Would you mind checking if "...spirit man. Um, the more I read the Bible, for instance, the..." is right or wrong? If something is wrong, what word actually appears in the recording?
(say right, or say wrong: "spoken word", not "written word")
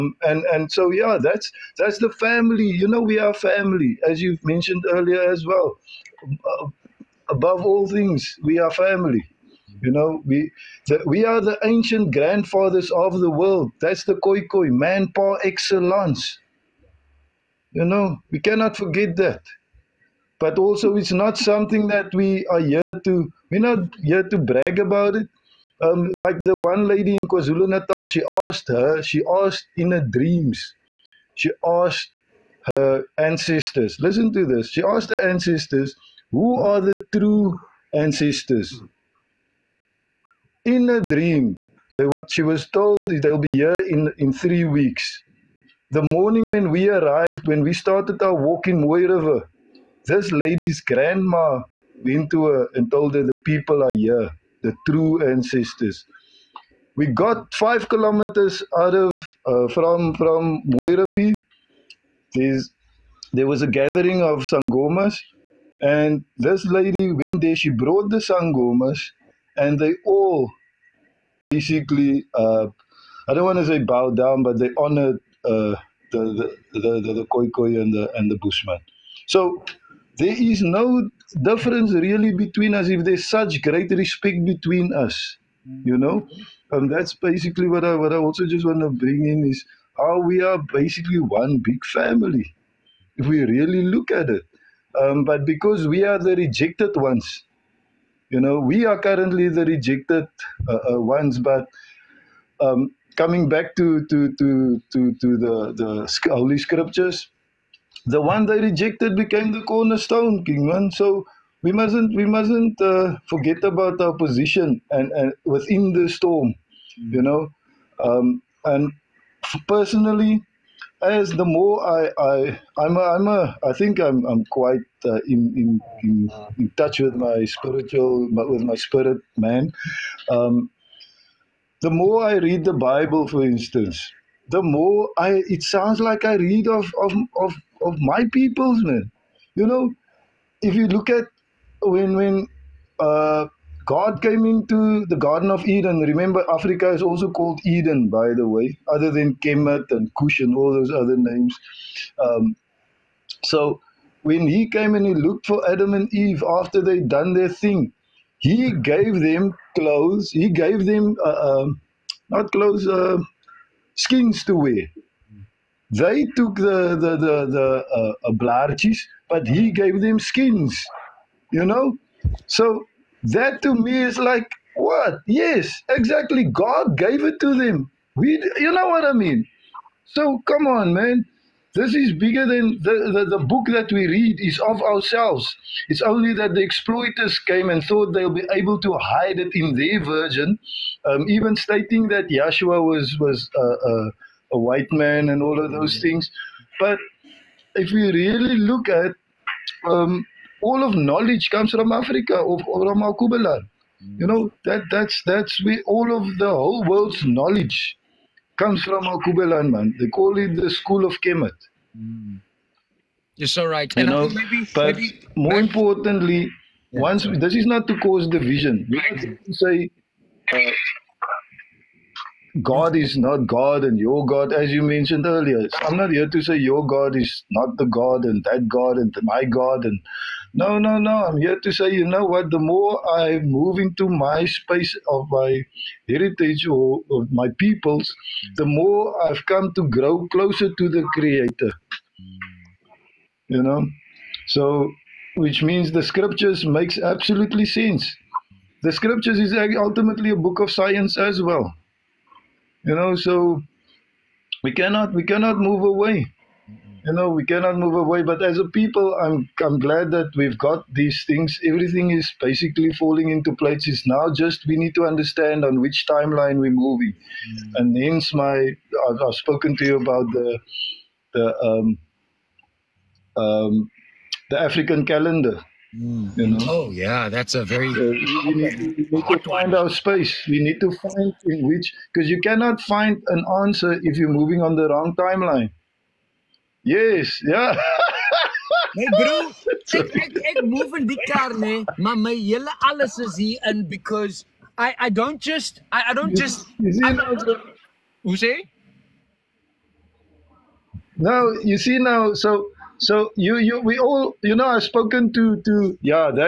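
right.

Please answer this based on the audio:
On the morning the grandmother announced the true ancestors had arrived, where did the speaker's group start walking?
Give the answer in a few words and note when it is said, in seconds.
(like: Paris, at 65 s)
Mooi River, at 48 s.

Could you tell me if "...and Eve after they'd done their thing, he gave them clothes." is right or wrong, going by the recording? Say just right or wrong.
right.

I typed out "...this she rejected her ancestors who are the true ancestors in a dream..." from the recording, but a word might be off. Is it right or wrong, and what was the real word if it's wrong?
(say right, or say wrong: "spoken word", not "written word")
wrong: "asked", not "rejected".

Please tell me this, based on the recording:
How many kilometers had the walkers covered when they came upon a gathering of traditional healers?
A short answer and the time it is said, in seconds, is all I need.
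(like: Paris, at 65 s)
5, at 57 s.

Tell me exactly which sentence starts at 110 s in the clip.
So we mustn't we mustn't uh, forget about our position and, and within the storm, hmm.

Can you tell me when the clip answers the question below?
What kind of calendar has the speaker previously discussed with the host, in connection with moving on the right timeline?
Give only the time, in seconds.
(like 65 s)
274 s.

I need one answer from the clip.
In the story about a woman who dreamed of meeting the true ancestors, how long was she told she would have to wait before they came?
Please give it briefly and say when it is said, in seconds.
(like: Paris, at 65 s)
3 weeks, at 44 s.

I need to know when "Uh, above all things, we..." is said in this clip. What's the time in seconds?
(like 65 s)
6 s.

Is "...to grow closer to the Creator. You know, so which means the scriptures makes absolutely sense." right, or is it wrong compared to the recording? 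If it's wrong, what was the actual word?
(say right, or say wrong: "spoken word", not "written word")
right.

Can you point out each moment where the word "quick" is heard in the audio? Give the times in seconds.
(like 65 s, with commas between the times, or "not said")
not said.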